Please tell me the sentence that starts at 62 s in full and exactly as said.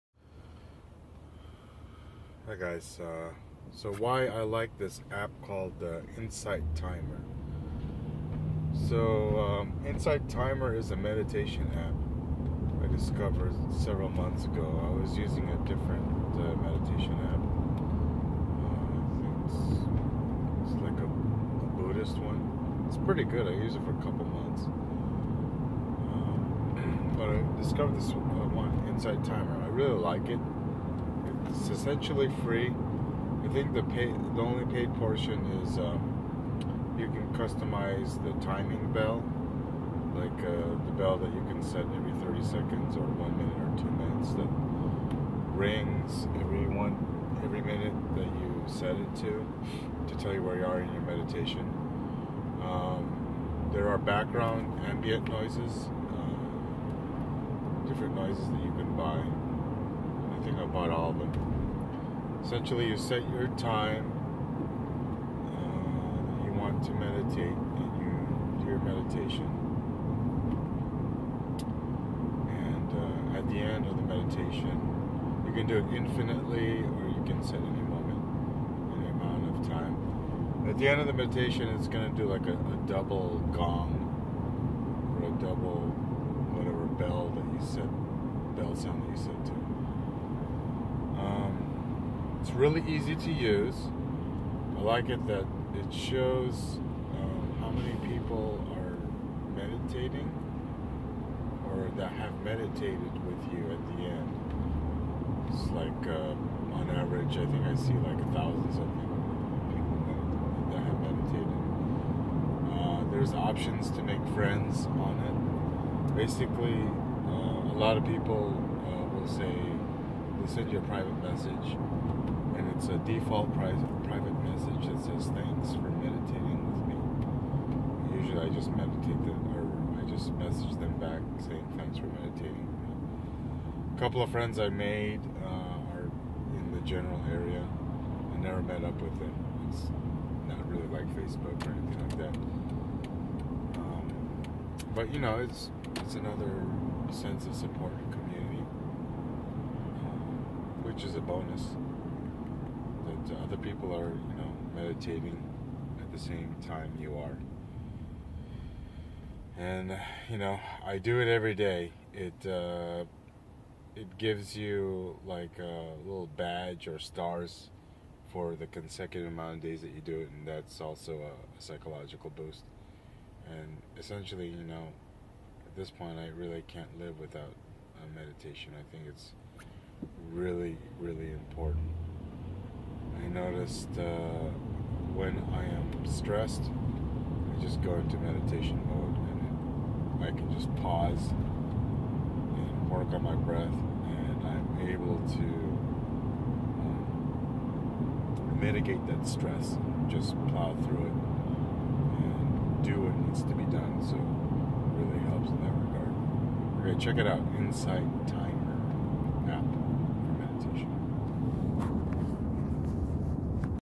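Essentially, you set your time uh, you want to meditate, and you do your meditation.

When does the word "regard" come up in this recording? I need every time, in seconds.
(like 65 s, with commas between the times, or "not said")
205 s.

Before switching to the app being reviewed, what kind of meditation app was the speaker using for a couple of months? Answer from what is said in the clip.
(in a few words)
Buddhist.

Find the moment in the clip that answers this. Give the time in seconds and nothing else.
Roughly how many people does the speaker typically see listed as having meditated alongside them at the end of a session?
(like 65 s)
108 s.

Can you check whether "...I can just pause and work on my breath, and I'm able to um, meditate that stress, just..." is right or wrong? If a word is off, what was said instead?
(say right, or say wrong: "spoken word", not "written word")
wrong: "mitigate", not "meditate".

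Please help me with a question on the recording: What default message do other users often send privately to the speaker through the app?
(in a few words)
thanks for meditating with me.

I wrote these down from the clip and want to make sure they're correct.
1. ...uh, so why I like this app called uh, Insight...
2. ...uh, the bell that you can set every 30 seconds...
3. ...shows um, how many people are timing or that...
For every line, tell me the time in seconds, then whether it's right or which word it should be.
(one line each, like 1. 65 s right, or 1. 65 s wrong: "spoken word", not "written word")
1. 3 s right
2. 40 s right
3. 95 s wrong: "meditating", not "timing".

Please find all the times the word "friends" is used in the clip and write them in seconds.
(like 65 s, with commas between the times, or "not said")
114 s, 134 s.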